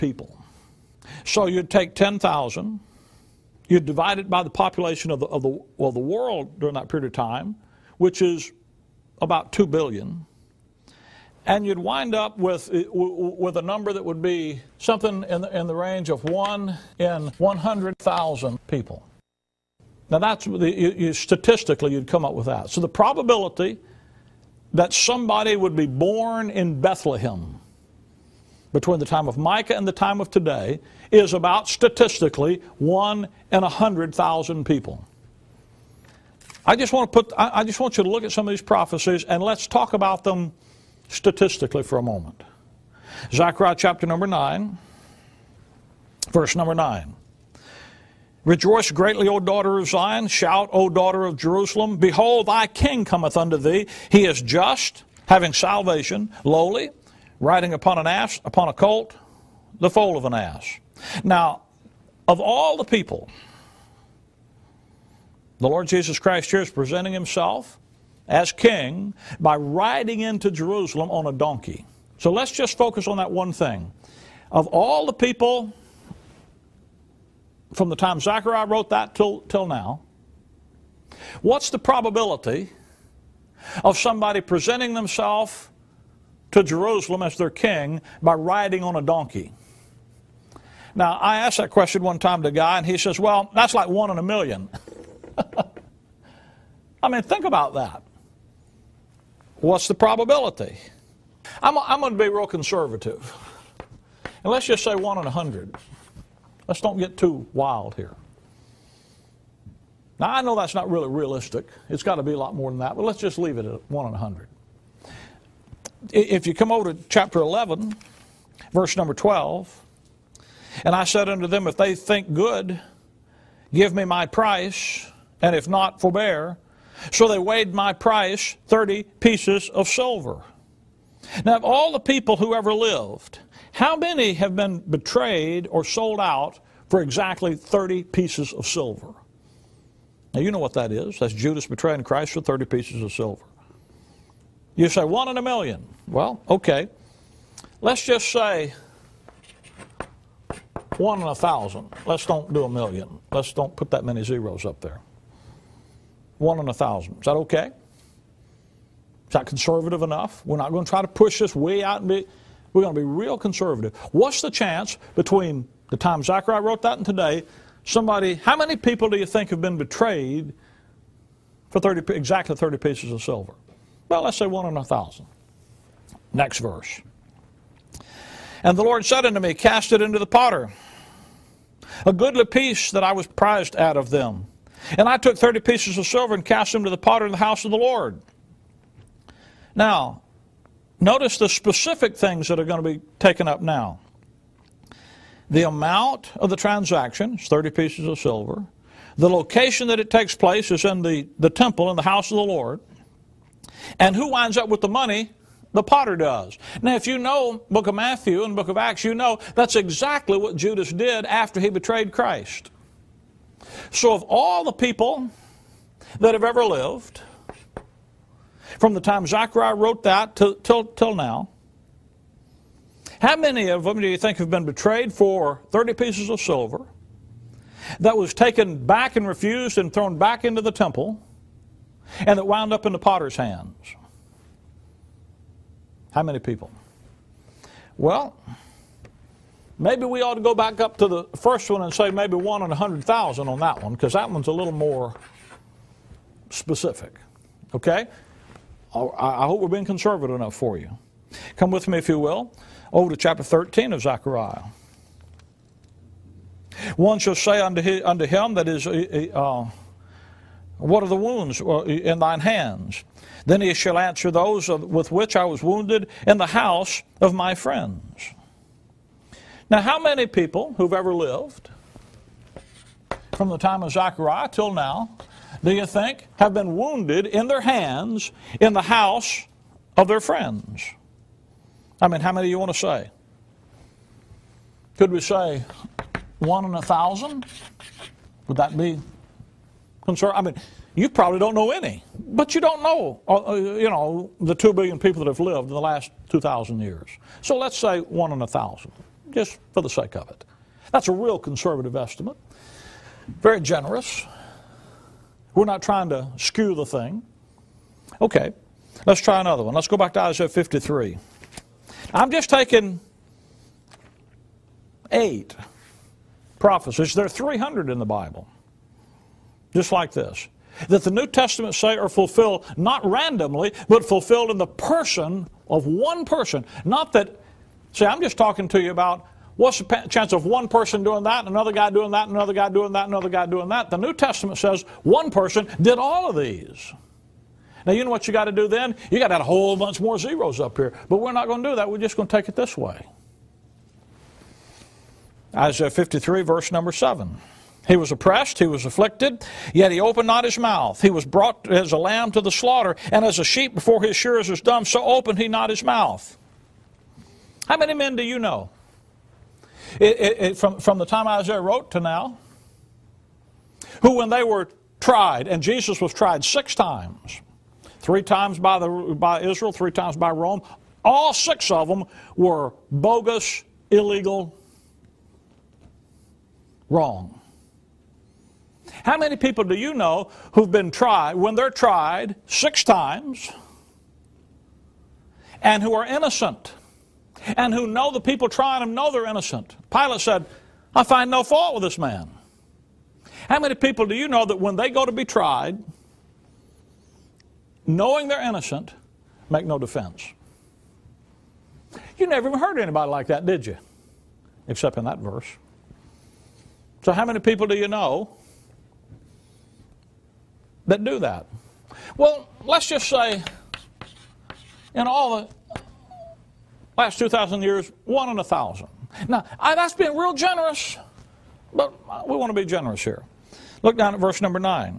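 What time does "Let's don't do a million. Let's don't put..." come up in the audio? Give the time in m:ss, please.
2:32.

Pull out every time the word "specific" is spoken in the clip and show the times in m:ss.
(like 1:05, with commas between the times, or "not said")
3:11, 4:06.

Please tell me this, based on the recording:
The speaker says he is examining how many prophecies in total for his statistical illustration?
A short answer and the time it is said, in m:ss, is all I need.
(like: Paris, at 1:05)
8, at 5:15.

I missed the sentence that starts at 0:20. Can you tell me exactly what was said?
Now that's you, you, statistically you'd come up with that.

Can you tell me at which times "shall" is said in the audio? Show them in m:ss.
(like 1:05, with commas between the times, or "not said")
4:17, 4:23.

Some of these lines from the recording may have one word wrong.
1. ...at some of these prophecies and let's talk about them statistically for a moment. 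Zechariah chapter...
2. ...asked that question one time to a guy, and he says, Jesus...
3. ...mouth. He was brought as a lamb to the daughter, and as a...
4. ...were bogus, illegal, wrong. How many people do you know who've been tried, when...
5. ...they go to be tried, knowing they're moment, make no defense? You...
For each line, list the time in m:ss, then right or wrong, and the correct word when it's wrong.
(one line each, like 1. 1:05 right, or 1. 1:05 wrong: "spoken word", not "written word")
1. 0:38 right
2. 1:31 wrong: "Well", not "Jesus"
3. 5:50 wrong: "slaughter", not "daughter"
4. 6:12 right
5. 6:34 wrong: "innocent", not "moment".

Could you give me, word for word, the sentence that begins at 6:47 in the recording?
So, how many people do you know that do that?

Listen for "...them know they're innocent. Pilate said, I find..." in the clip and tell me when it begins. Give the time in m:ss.
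6:28.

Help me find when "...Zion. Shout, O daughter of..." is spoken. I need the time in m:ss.
0:49.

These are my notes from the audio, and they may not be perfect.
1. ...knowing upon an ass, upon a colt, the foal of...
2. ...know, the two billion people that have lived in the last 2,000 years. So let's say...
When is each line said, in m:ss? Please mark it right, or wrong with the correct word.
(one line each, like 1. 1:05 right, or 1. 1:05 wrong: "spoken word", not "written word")
1. 0:57 wrong: "riding", not "knowing"
2. 4:53 right.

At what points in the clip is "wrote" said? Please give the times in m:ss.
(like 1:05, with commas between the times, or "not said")
1:18, 2:46, 3:39, 6:01.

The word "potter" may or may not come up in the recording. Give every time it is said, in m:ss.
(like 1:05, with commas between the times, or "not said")
3:00, 3:06, 3:25, 3:52.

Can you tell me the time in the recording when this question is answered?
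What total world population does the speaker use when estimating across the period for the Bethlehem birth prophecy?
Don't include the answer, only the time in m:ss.
0:09.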